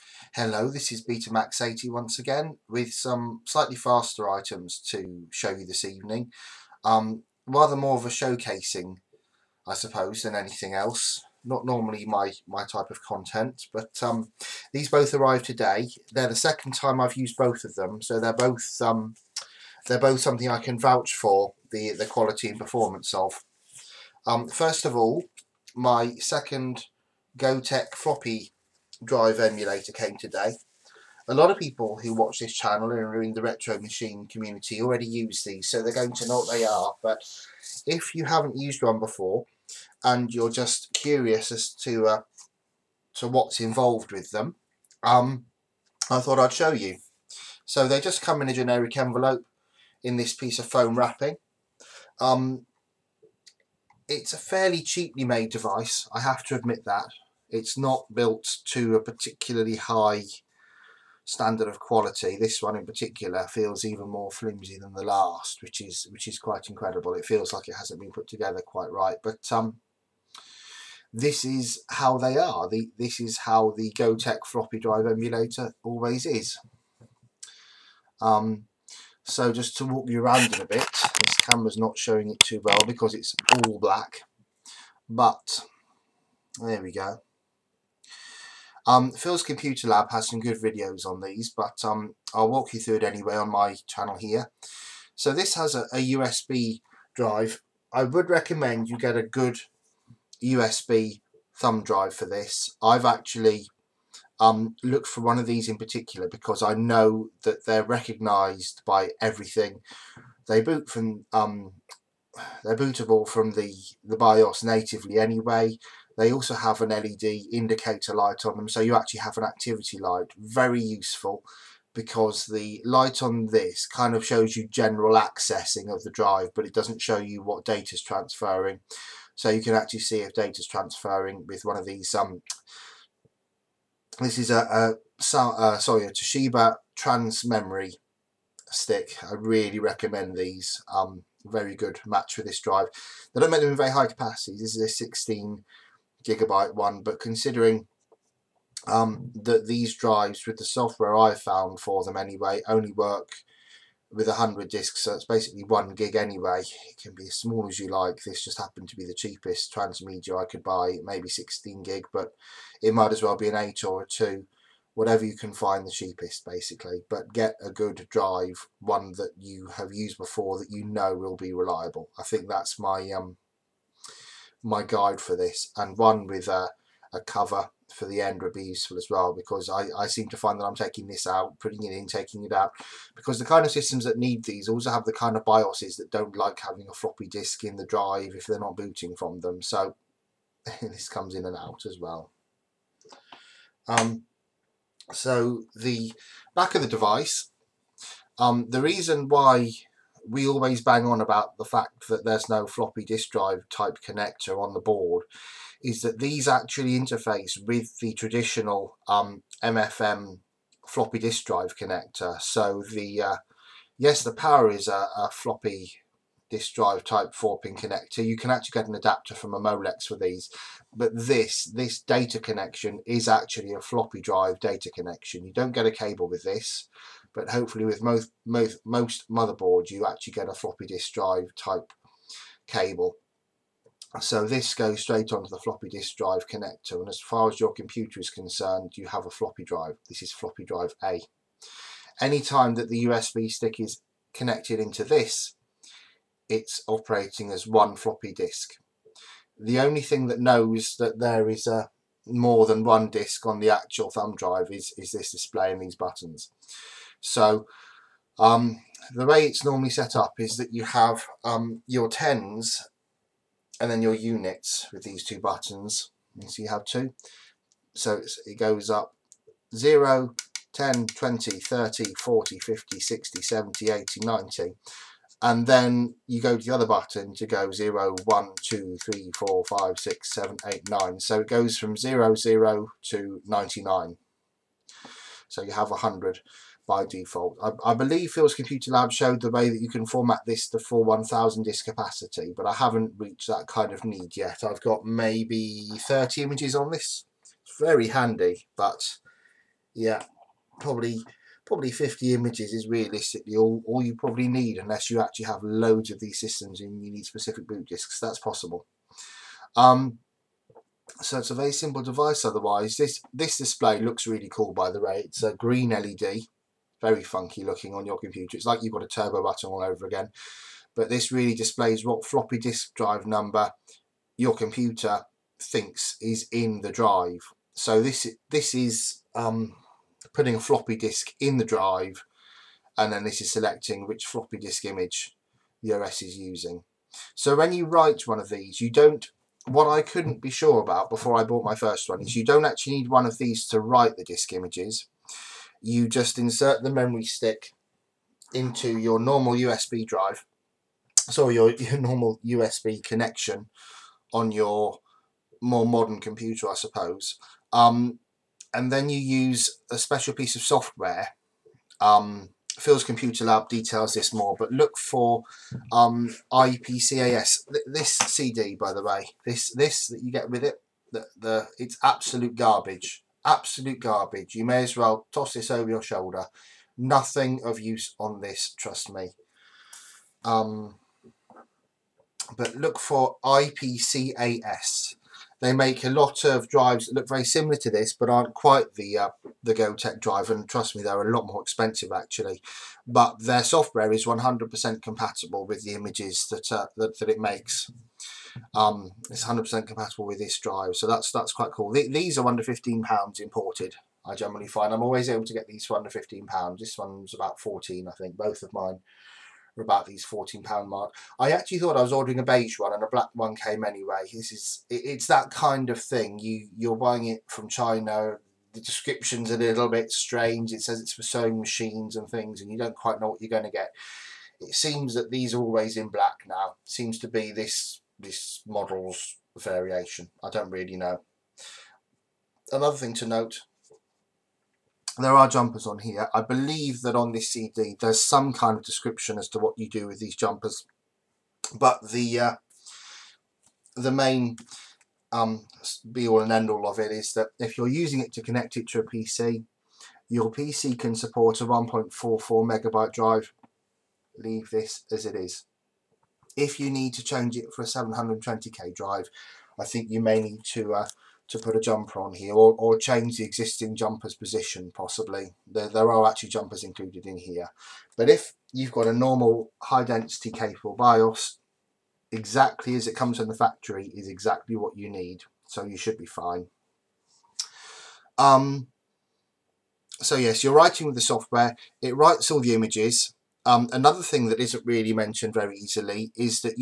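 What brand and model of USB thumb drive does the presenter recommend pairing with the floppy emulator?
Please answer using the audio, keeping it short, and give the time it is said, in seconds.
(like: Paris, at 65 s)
Toshiba TransMemory, at 136 s.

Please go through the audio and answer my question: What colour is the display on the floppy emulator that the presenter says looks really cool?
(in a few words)
green.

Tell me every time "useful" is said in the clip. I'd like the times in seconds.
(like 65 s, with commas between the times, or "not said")
120 s, 178 s.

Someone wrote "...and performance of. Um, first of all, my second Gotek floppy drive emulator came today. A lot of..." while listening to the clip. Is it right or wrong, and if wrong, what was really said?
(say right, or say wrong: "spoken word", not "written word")
right.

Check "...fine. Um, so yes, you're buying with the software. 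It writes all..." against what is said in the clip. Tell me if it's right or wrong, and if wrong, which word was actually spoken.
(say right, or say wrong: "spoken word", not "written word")
wrong: "writing", not "buying".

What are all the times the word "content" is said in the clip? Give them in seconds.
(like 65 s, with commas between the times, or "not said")
13 s.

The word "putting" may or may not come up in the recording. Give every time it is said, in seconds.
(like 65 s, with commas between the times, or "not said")
181 s, 330 s.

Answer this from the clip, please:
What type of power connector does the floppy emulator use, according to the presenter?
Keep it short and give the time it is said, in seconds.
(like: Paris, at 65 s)
four pin connector, at 217 s.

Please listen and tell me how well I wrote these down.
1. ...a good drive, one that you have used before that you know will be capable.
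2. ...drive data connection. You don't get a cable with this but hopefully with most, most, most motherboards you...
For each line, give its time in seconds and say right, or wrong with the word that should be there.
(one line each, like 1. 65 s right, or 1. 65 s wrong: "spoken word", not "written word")
1. 167 s wrong: "reliable", not "capable"
2. 224 s right.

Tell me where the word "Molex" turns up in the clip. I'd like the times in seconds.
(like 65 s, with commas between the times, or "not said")
219 s.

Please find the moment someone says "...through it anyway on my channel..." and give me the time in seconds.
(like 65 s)
92 s.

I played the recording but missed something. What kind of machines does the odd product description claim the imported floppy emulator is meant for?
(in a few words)
sewing machines.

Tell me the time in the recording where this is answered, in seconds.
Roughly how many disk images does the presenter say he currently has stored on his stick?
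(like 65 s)
295 s.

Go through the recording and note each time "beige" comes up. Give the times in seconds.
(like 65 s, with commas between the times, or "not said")
412 s.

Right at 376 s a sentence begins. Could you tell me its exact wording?
Nothing of use on this, trust me.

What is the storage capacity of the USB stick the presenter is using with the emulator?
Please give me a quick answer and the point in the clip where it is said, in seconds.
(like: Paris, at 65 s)
16 gigabytes, at 144 s.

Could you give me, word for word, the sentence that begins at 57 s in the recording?
It's not built to a particularly high standard of quality.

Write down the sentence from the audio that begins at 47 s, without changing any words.
So they just come in a generic envelope in this piece of foam wrapping.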